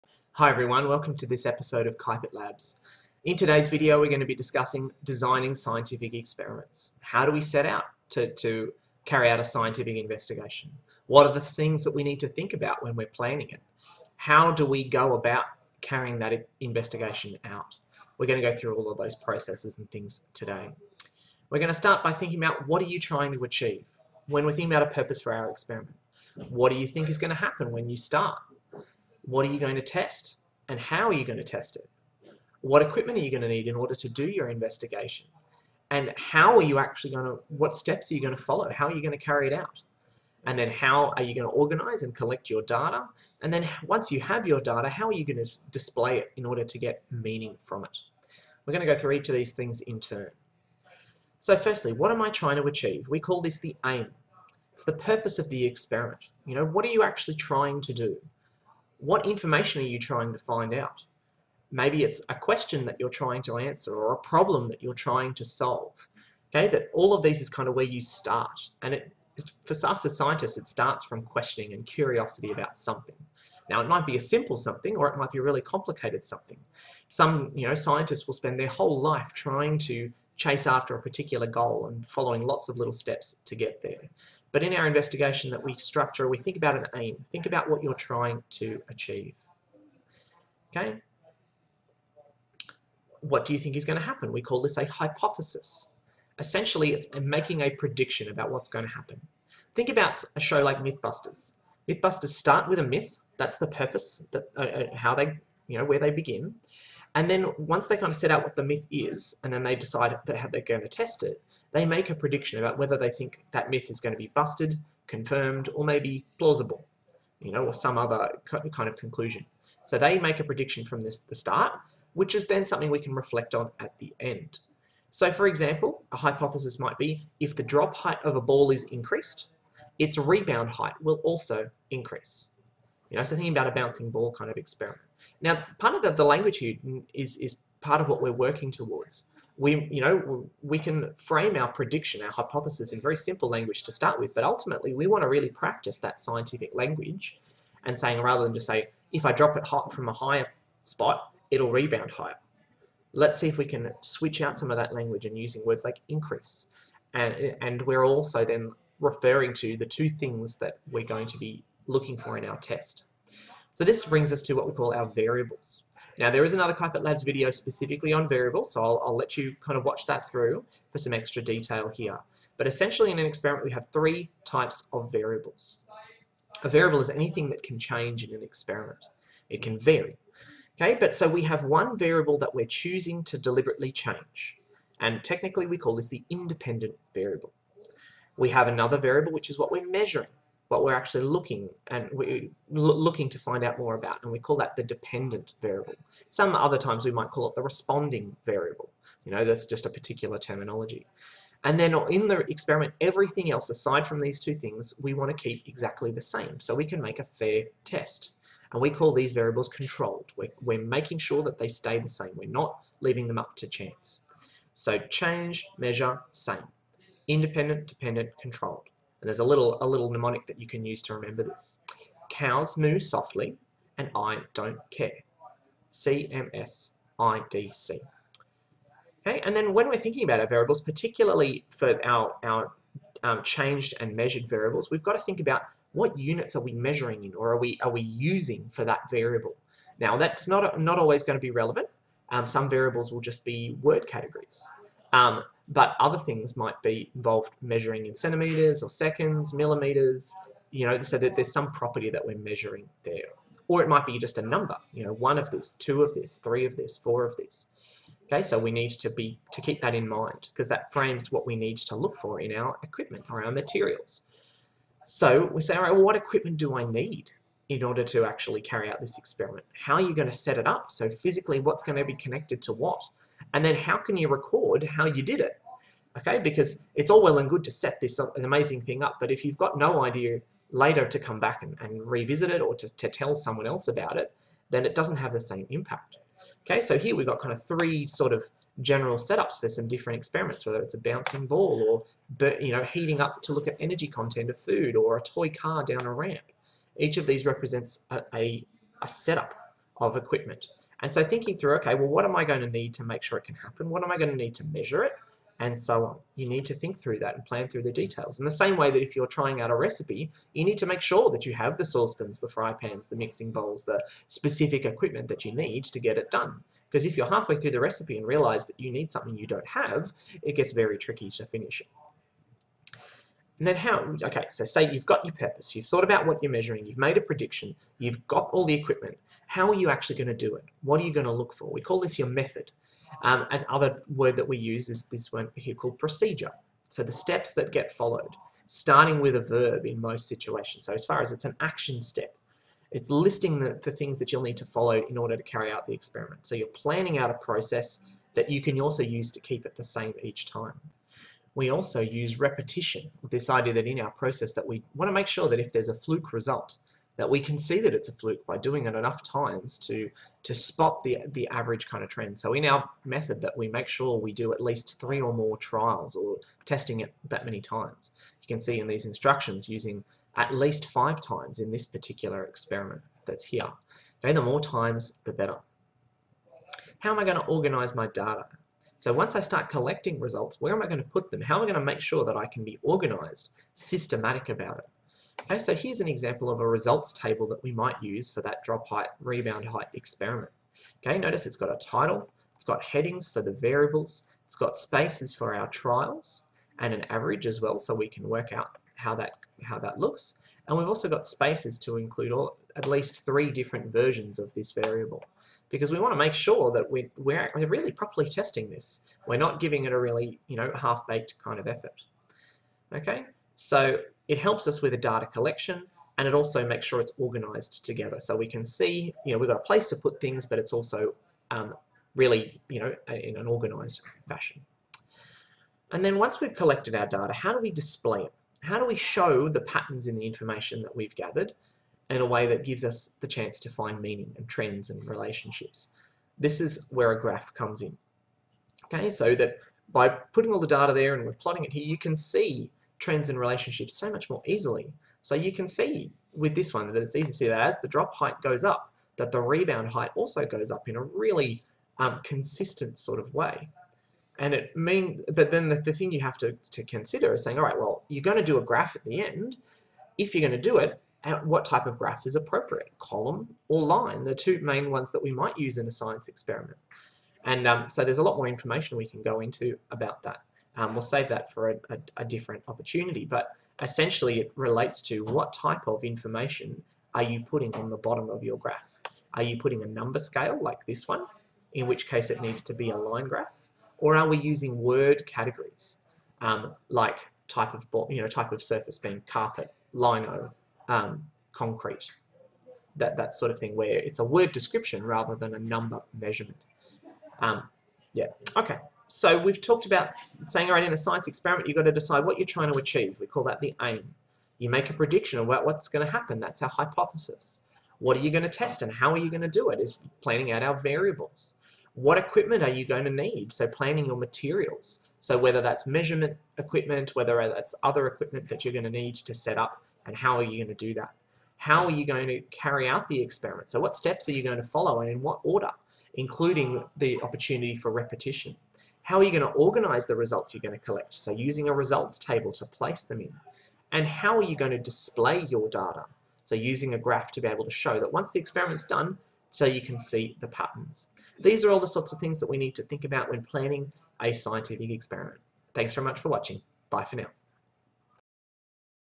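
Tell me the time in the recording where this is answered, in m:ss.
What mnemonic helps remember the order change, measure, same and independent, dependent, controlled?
3:42.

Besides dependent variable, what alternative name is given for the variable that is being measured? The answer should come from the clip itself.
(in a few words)
responding variable.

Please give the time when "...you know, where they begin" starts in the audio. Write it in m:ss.
1:45.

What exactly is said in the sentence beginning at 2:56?
A variable is anything that can change in an experiment.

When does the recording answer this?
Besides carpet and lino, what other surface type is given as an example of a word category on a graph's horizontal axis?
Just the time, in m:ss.
8:11.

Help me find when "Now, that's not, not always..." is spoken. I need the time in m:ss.
3:59.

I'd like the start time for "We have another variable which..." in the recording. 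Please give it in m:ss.
3:08.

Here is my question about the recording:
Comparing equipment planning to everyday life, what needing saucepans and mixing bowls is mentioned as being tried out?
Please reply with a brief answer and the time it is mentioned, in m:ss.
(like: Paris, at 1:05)
a recipe, at 5:09.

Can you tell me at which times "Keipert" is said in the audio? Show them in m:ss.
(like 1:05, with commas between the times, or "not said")
0:01, 2:46.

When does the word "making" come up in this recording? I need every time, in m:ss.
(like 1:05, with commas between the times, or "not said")
1:37, 3:30.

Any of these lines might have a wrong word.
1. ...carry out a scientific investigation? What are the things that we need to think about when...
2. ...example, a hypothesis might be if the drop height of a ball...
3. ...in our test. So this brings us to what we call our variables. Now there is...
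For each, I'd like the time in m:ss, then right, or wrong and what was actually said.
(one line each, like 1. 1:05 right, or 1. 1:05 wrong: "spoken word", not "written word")
1. 0:09 right
2. 2:05 right
3. 2:42 right.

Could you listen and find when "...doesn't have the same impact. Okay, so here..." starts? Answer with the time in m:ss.
4:44.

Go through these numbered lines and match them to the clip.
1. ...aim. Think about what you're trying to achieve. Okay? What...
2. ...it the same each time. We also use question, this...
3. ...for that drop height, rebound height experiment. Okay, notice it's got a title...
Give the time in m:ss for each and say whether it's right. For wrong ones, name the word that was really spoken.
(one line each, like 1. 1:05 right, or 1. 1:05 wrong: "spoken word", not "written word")
1. 1:26 right
2. 5:49 wrong: "repetition", not "question"
3. 6:28 right.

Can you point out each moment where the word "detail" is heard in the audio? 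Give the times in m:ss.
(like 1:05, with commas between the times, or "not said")
2:51, 5:07.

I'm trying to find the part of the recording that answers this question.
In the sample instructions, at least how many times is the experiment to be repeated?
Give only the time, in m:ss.
6:10.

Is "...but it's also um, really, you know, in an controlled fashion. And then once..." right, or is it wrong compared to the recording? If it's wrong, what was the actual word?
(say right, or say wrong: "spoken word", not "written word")
wrong: "organized", not "controlled".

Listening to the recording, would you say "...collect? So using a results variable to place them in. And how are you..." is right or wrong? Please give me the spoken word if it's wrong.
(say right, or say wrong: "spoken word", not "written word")
wrong: "table", not "variable".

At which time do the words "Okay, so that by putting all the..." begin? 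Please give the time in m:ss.
7:18.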